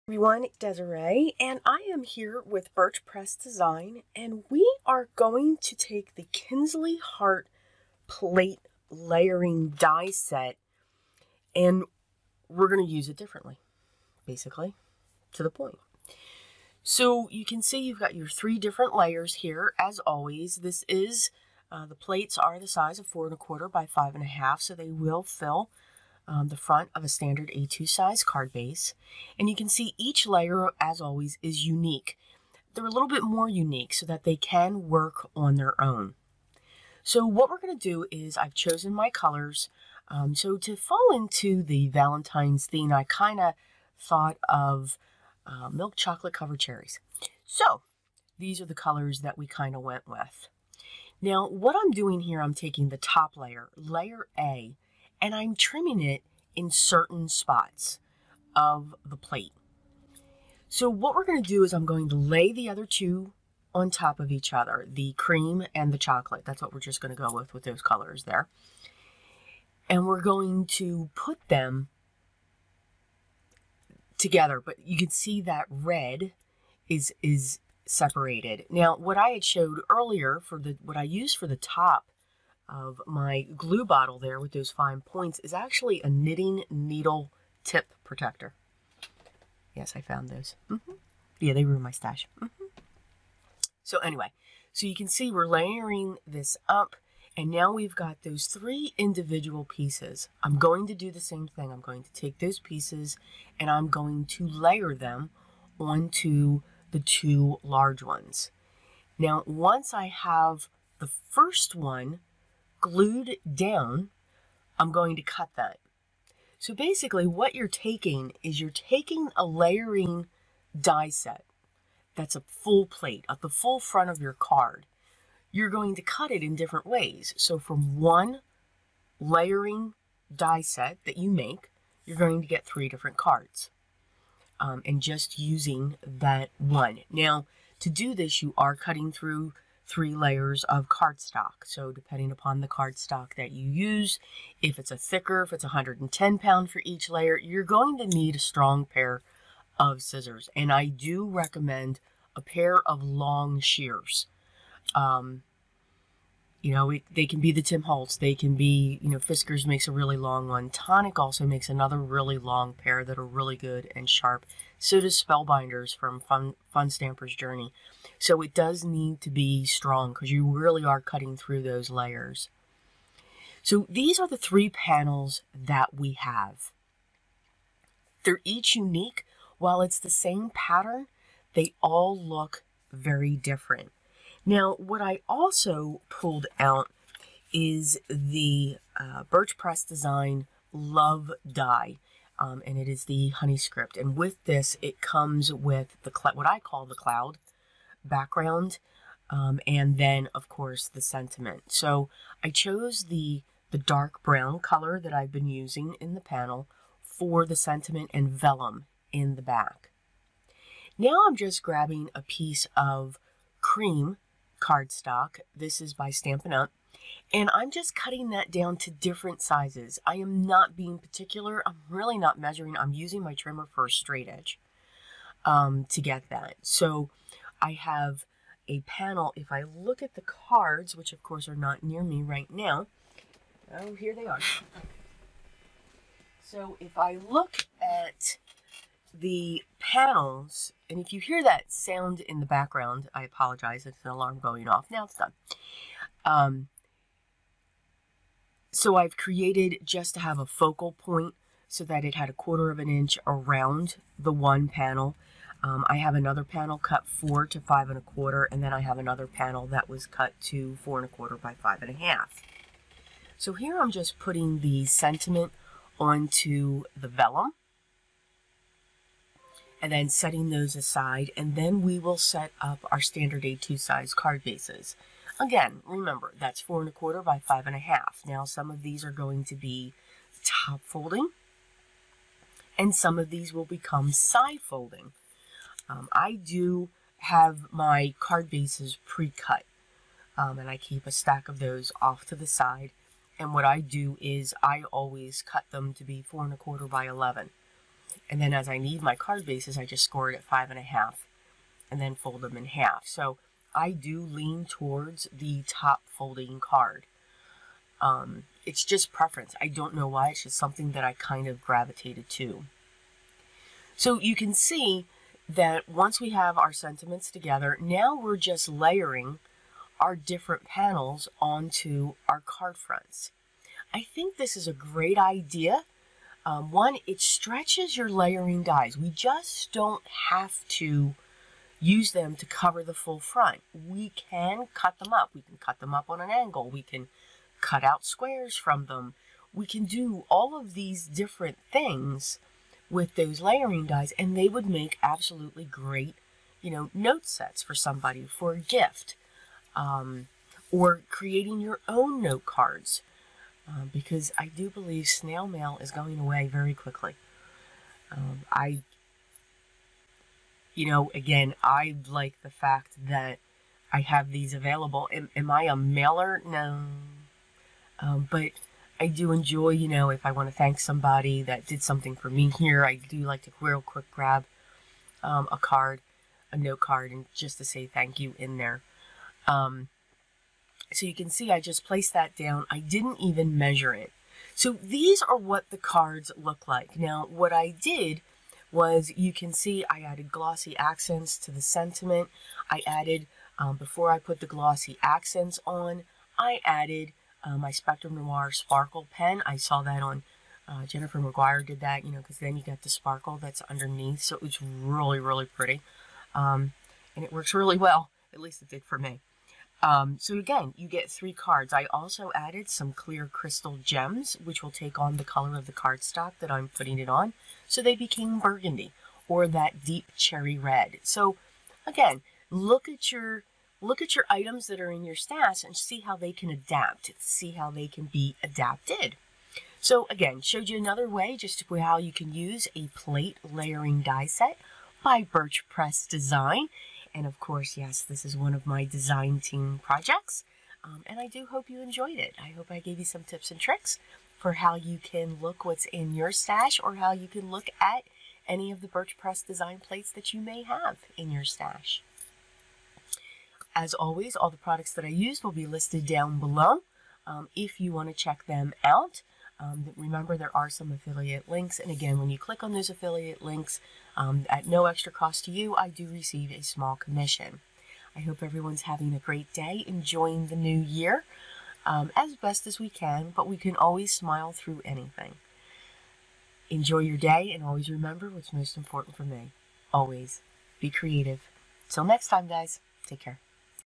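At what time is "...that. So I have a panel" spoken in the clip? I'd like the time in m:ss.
3:46.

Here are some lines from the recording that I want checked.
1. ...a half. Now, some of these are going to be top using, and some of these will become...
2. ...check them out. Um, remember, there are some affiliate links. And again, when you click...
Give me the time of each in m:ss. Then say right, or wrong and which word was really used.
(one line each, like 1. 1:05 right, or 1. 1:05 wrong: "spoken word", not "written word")
1. 4:37 wrong: "folding", not "using"
2. 7:38 right.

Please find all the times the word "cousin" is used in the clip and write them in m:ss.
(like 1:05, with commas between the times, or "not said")
not said.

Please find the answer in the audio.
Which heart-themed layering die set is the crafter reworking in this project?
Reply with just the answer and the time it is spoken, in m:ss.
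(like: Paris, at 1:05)
Kinsley Heart, at 0:06.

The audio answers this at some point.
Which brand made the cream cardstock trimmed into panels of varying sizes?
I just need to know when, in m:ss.
3:36.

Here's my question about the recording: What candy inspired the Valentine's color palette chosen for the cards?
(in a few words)
Milk chocolate covered cherries.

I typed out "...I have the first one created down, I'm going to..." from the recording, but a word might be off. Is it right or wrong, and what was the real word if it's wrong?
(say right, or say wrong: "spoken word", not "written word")
wrong: "glued", not "created".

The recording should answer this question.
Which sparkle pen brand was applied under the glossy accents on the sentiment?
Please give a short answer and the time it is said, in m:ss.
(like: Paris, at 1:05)
Spectrum Noir, at 6:37.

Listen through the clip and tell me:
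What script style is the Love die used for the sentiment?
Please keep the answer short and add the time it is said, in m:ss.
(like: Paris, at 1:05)
Honey script, at 3:13.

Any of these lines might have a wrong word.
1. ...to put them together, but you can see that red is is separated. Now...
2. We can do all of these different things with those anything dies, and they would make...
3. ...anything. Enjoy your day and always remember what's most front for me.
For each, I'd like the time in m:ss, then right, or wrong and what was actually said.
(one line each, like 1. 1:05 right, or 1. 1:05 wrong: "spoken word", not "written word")
1. 1:10 right
2. 5:39 wrong: "layering", not "anything"
3. 7:54 wrong: "important", not "front".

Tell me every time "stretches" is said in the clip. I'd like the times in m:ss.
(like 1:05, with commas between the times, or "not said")
5:27.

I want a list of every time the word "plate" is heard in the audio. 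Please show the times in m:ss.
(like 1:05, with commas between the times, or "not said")
0:08, 0:21, 0:59, 2:02, 7:12, 7:29.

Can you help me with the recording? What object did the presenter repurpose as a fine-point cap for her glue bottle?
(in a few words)
Knitting needle tip protector.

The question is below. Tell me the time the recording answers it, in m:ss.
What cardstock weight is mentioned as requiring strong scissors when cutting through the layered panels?
2:25.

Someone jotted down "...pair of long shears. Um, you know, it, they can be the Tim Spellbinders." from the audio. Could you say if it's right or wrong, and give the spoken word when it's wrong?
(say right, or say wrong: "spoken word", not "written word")
wrong: "Holtz", not "Spellbinders".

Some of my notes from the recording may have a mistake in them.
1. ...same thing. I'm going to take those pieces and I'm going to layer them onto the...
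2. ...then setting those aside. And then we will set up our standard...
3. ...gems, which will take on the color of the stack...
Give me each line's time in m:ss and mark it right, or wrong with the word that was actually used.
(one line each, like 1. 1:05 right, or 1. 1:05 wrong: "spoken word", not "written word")
1. 1:41 right
2. 4:29 right
3. 6:53 wrong: "cardstock", not "stack".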